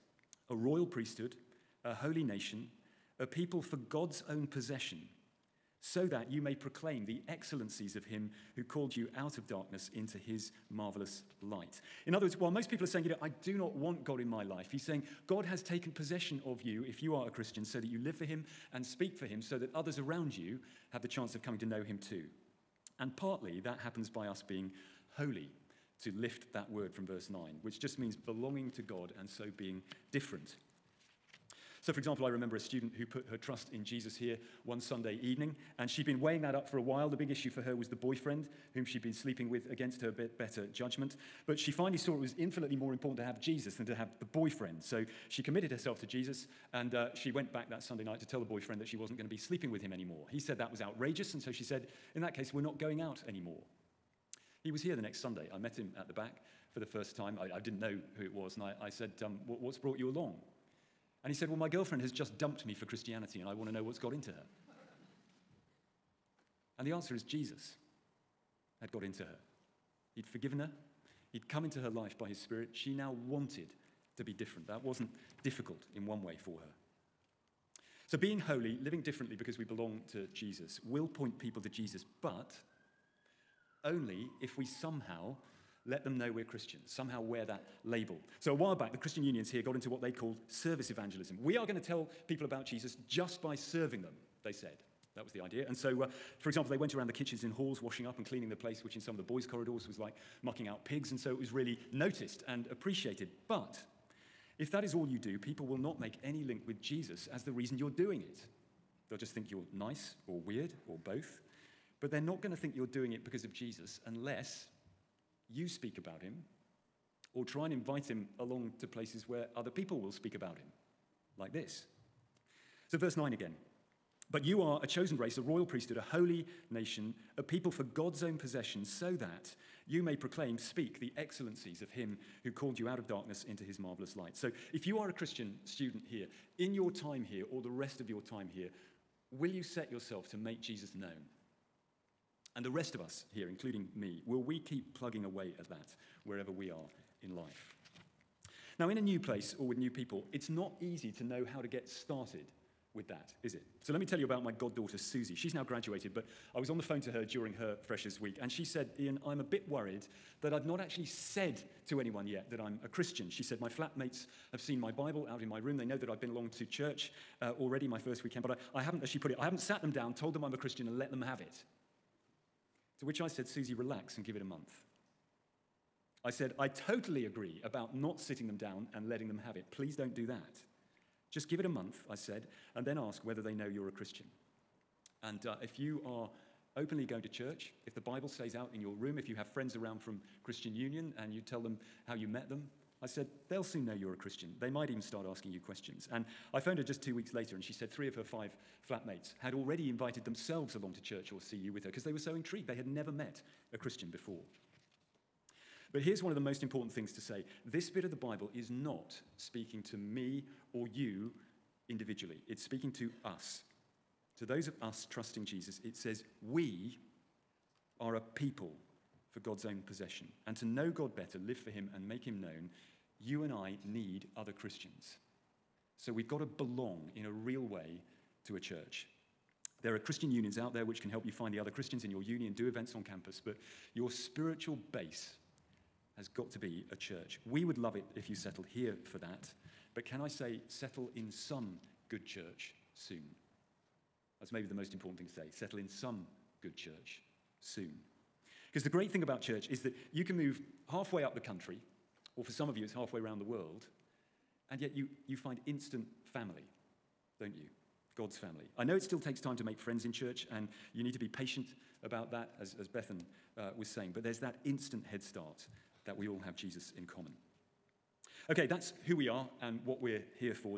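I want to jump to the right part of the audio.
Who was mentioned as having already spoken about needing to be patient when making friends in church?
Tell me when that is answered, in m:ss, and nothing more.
4:22.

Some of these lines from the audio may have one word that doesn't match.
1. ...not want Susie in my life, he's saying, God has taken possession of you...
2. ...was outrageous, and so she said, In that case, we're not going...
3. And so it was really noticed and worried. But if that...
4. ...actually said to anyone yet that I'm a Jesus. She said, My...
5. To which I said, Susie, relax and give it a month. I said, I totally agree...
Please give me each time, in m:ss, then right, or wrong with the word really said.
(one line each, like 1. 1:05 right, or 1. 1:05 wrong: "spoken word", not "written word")
1. 0:13 wrong: "God", not "Susie"
2. 0:50 right
3. 1:41 wrong: "appreciated", not "worried"
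4. 2:40 wrong: "Christian", not "Jesus"
5. 2:52 right.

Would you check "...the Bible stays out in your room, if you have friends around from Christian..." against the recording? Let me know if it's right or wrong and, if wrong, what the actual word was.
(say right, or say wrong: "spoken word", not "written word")
right.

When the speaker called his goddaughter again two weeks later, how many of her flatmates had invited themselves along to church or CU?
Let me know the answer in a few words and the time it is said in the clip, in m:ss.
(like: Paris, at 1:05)
3, at 3:17.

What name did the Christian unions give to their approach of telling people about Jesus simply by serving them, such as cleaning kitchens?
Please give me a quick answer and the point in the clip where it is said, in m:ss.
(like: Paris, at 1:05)
service evangelism, at 1:30.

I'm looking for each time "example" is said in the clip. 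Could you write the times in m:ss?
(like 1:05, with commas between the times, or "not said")
0:31, 1:36.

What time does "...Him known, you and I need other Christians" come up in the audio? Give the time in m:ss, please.
3:42.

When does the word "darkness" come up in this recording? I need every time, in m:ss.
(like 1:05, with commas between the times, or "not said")
0:09, 2:13.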